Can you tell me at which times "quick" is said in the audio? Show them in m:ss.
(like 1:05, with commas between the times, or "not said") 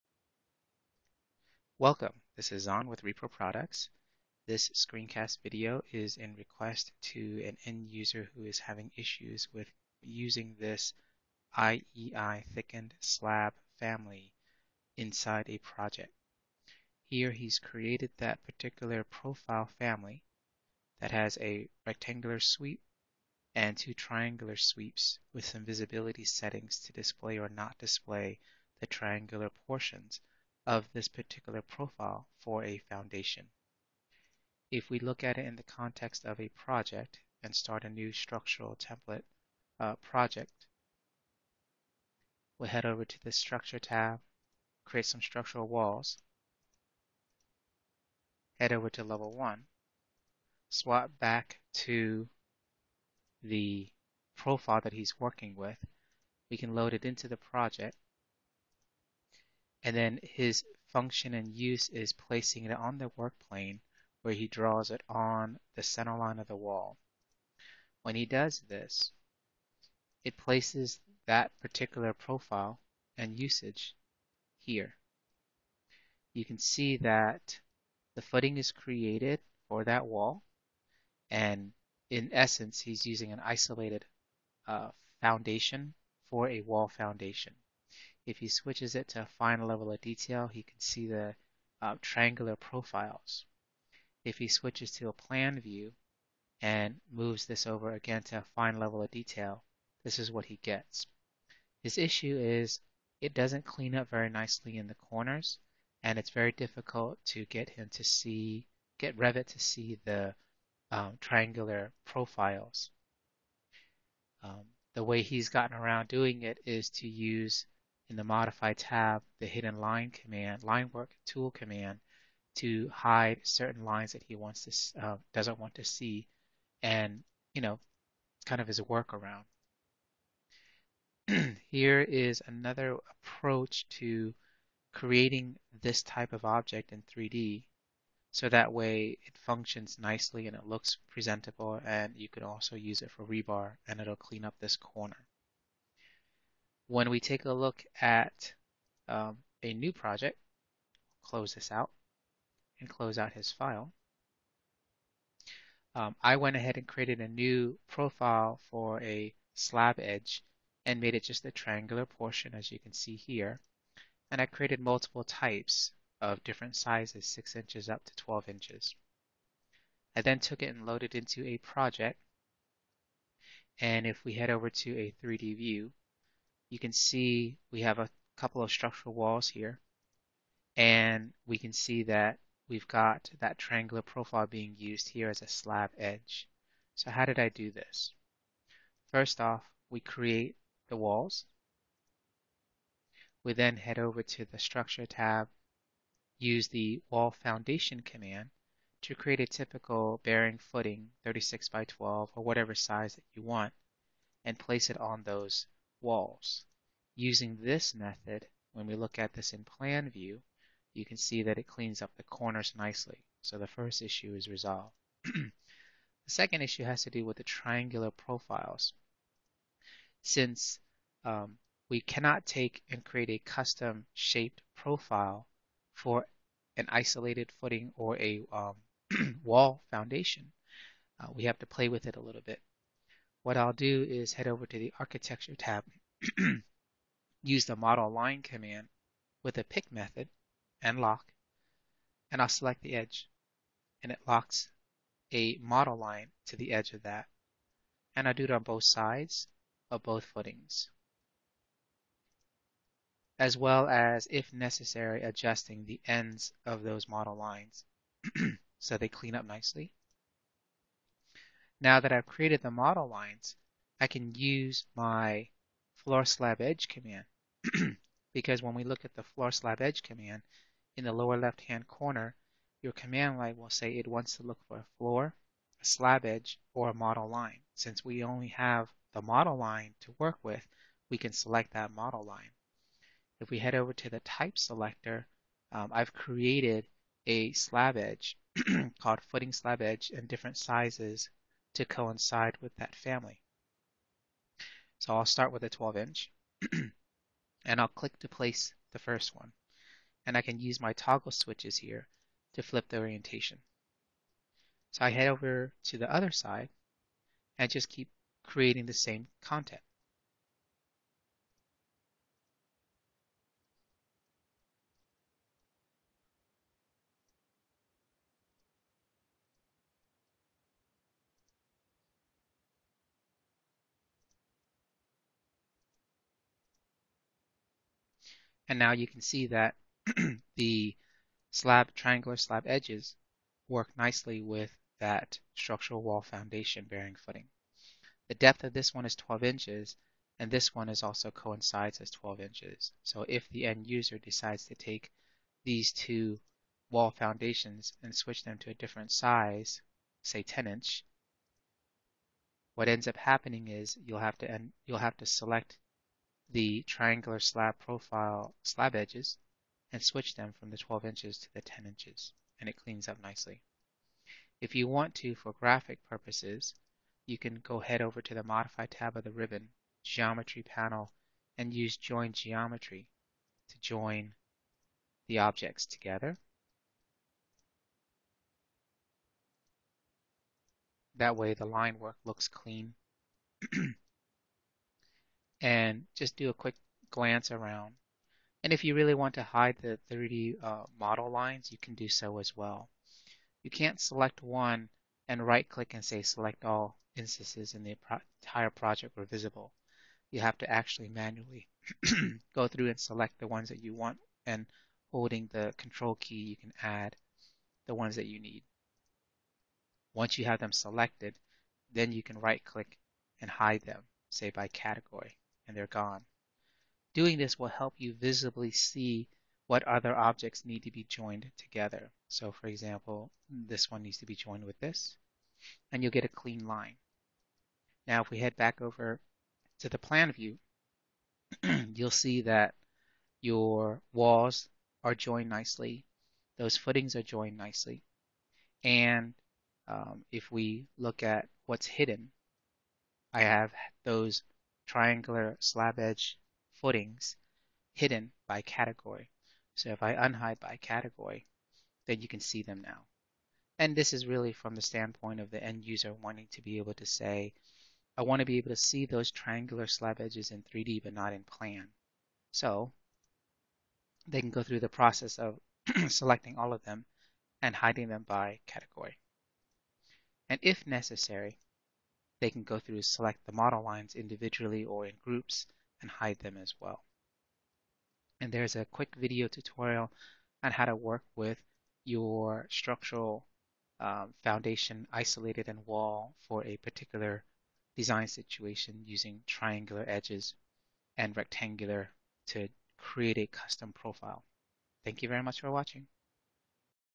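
6:26, 7:58.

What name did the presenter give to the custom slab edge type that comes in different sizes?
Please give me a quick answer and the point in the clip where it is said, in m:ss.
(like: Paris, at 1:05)
footing slab edge, at 4:49.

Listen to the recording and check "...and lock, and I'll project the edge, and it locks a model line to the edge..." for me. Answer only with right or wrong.
wrong.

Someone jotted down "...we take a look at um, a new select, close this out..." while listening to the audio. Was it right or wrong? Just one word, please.
wrong.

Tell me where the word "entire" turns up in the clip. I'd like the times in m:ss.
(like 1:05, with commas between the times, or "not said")
6:38.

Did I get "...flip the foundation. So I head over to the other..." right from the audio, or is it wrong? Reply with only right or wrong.
wrong.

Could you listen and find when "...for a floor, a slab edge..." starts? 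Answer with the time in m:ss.
4:34.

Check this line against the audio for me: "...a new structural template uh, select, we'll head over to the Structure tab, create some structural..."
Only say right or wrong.
wrong.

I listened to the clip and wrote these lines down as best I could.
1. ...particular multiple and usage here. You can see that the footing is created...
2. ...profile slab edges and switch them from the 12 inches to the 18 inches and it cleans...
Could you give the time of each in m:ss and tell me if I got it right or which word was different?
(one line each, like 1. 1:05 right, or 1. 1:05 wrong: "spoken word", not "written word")
1. 1:11 wrong: "profile", not "multiple"
2. 5:57 wrong: "10", not "18".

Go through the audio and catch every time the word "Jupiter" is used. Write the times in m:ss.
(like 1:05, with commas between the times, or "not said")
not said.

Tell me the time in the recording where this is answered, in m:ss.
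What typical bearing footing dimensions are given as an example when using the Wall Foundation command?
3:21.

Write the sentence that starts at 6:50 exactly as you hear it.
Once you have them selected, then you can right click and hide them, say by category and they're gone.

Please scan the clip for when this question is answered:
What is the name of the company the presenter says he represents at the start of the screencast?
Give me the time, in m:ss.
0:03.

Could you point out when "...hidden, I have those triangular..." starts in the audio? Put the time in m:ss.
7:21.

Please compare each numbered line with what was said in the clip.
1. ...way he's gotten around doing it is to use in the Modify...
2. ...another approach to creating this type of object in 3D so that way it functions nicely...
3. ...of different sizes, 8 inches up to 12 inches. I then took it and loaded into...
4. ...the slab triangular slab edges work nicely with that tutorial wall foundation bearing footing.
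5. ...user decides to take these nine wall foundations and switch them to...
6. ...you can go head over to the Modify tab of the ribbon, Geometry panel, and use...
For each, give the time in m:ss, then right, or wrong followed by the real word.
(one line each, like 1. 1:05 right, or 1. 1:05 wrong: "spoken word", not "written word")
1. 1:55 right
2. 2:12 right
3. 2:46 wrong: "6", not "8"
4. 5:30 wrong: "structural", not "tutorial"
5. 5:43 wrong: "two", not "nine"
6. 6:07 right.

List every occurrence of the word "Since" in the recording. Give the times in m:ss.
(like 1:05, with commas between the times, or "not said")
3:40, 4:37.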